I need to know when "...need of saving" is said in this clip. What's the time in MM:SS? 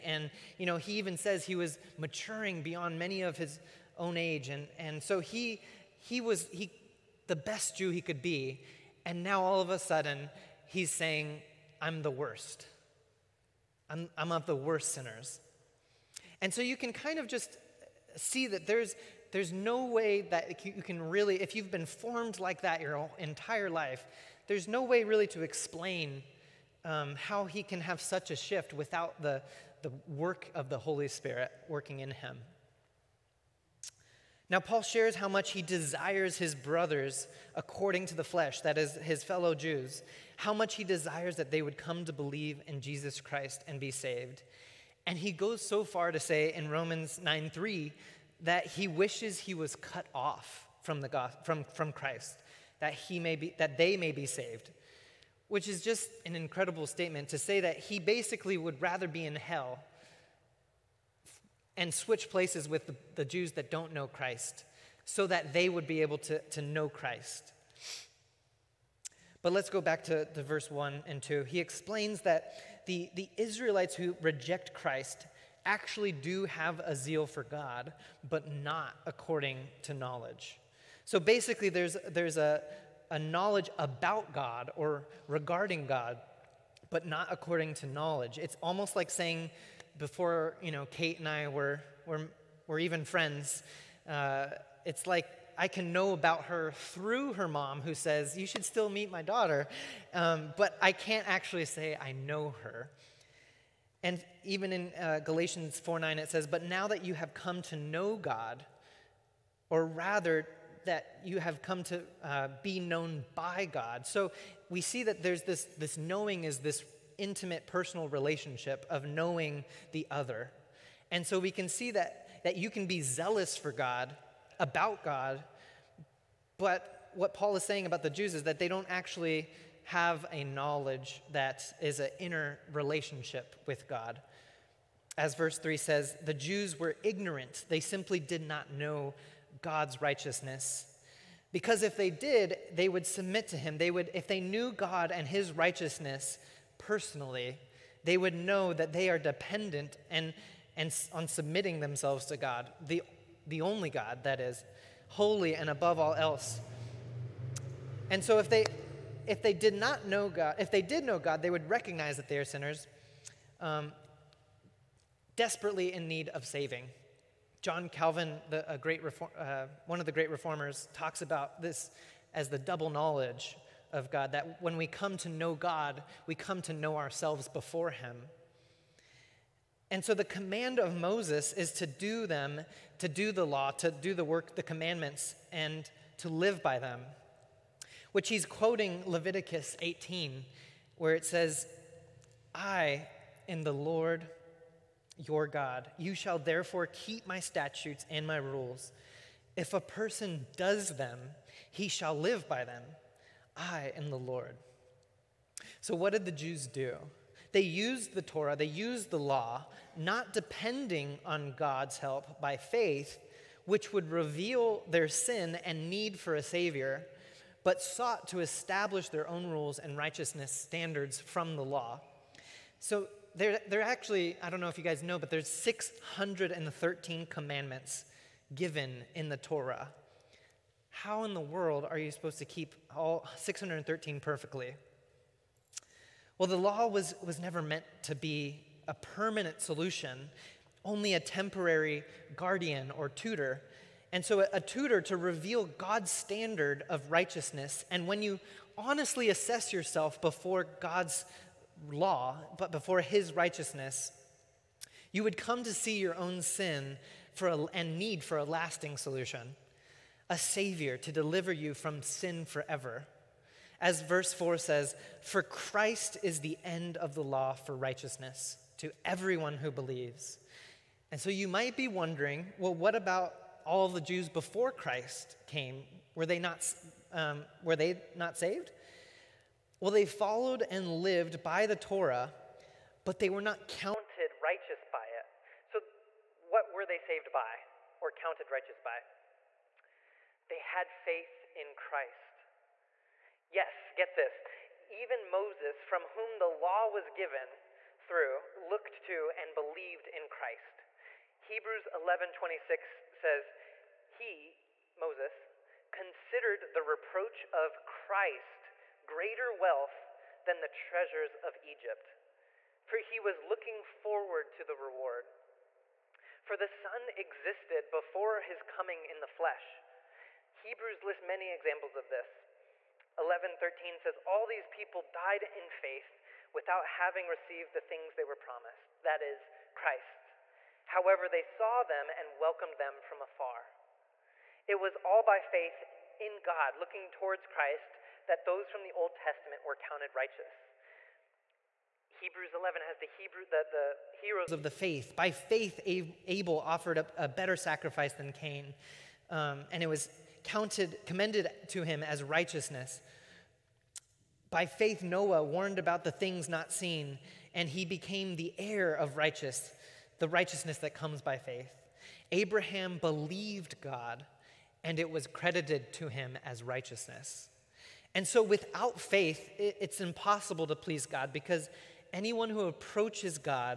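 02:46.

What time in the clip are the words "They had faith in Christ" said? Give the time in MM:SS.
04:50.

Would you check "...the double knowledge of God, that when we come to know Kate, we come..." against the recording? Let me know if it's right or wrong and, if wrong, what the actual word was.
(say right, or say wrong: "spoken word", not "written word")
wrong: "God", not "Kate".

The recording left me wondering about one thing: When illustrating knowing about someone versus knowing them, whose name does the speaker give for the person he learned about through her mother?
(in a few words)
Kate.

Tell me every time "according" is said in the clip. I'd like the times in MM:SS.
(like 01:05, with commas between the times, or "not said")
00:37, 01:19, 01:27.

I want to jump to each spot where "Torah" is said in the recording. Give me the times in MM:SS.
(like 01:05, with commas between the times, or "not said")
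03:28, 03:49, 04:41.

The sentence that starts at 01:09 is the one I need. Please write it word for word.
But let's go back to, to verse 1 and 2.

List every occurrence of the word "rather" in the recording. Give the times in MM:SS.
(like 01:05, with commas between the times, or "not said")
00:58, 01:49.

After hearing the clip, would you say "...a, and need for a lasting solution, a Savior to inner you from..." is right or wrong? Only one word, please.
wrong.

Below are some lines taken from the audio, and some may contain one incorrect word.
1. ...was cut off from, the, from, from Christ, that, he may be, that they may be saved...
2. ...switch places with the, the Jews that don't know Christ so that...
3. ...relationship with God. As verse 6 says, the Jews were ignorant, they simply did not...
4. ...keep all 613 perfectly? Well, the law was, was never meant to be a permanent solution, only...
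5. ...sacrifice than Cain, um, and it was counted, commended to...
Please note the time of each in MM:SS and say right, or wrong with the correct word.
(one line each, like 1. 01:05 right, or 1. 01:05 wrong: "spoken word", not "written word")
1. 00:49 right
2. 01:01 right
3. 02:12 wrong: "3", not "6"
4. 03:52 right
5. 05:47 right.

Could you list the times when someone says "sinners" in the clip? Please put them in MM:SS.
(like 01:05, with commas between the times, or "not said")
00:14, 02:42.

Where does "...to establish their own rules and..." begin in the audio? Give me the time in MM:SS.
03:38.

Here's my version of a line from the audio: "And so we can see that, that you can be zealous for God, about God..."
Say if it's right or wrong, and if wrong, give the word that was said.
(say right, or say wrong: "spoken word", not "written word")
right.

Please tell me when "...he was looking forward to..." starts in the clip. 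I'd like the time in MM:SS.
05:12.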